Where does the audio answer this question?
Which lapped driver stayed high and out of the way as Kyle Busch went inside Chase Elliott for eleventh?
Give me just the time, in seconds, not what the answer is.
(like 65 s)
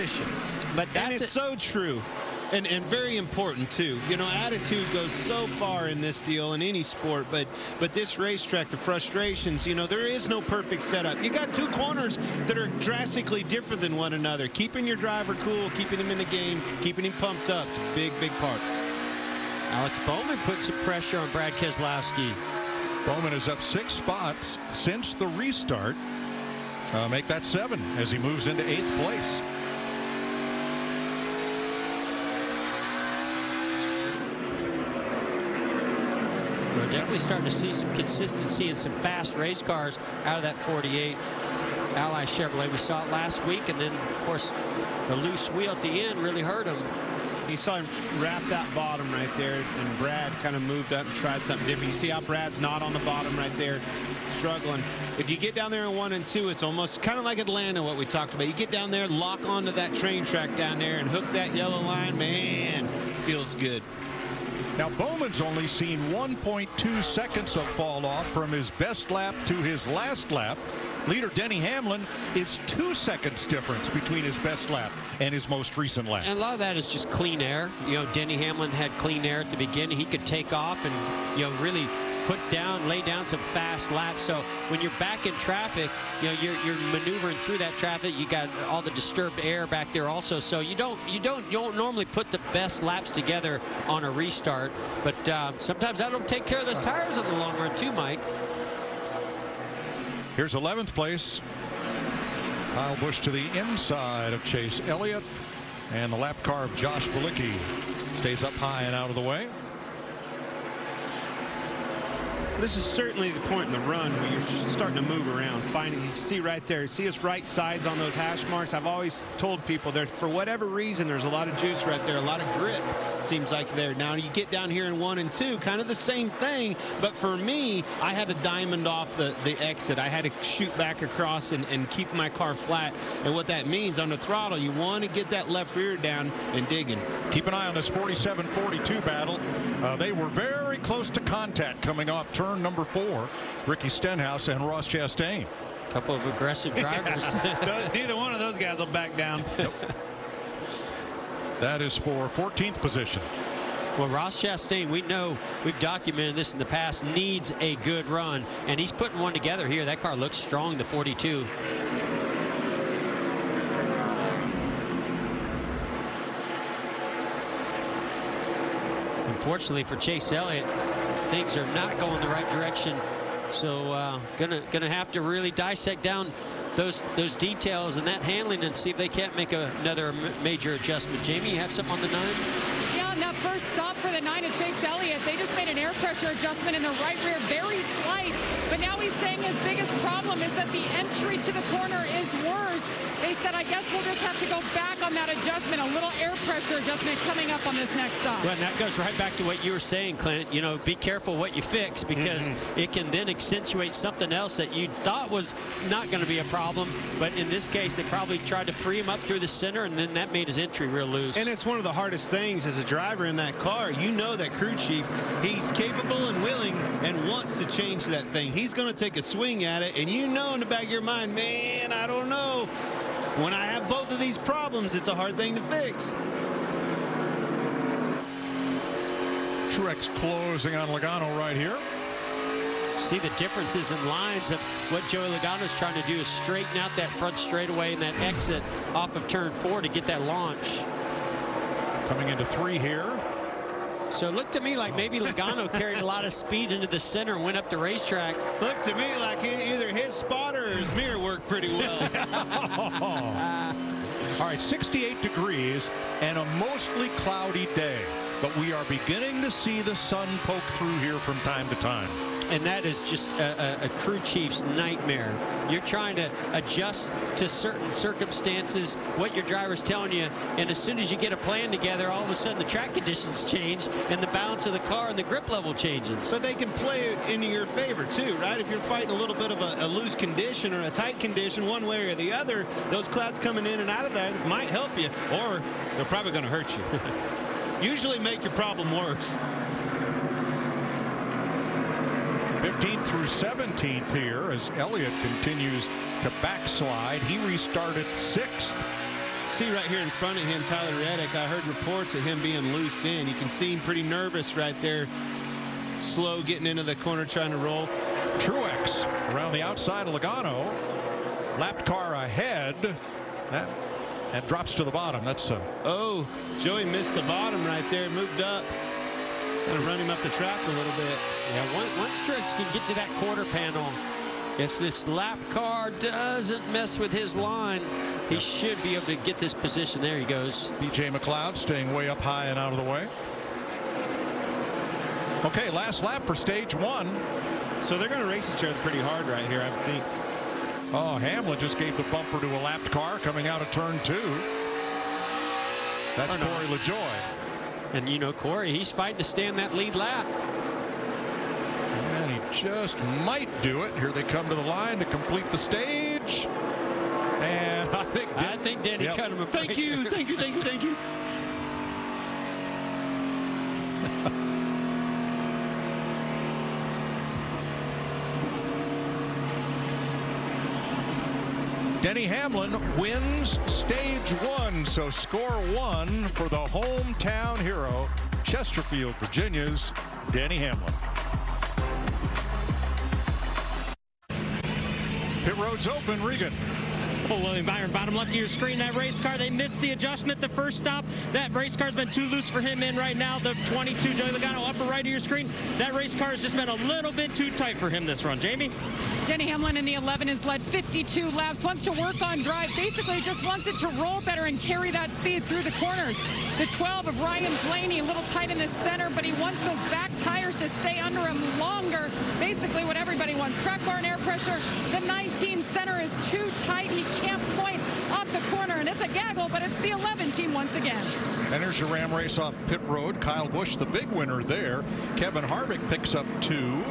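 106 s.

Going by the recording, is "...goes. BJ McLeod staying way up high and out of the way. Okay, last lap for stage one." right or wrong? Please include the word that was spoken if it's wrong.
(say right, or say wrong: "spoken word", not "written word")
right.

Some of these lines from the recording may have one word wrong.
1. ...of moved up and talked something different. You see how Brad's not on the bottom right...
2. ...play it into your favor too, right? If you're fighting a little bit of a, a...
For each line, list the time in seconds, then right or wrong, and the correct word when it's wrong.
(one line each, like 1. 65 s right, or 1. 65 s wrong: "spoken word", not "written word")
1. 50 s wrong: "tried", not "talked"
2. 276 s right.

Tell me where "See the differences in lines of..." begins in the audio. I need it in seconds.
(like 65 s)
232 s.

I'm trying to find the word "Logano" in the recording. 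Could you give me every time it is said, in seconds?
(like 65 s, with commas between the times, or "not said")
230 s, 235 s, 245 s, 310 s, 394 s.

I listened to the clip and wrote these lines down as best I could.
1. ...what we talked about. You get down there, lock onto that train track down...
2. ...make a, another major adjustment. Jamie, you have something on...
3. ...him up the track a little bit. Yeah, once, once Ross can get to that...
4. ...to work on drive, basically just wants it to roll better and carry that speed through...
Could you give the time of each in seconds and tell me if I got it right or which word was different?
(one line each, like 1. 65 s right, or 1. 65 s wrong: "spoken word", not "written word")
1. 57 s right
2. 179 s right
3. 319 s wrong: "Truex", not "Ross"
4. 401 s right.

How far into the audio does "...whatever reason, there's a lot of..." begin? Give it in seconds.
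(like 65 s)
120 s.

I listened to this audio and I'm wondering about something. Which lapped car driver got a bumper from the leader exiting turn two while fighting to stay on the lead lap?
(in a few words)
Corey LaJoie.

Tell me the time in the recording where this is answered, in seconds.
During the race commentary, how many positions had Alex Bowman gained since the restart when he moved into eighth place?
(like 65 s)
27 s.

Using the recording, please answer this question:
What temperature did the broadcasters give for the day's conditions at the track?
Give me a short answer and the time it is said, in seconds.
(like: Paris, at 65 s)
68 degrees, at 254 s.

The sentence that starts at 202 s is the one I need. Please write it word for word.
it can then accentuate something else that you thought was not going to be a problem.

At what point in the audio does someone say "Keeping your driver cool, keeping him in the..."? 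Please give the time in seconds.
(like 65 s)
14 s.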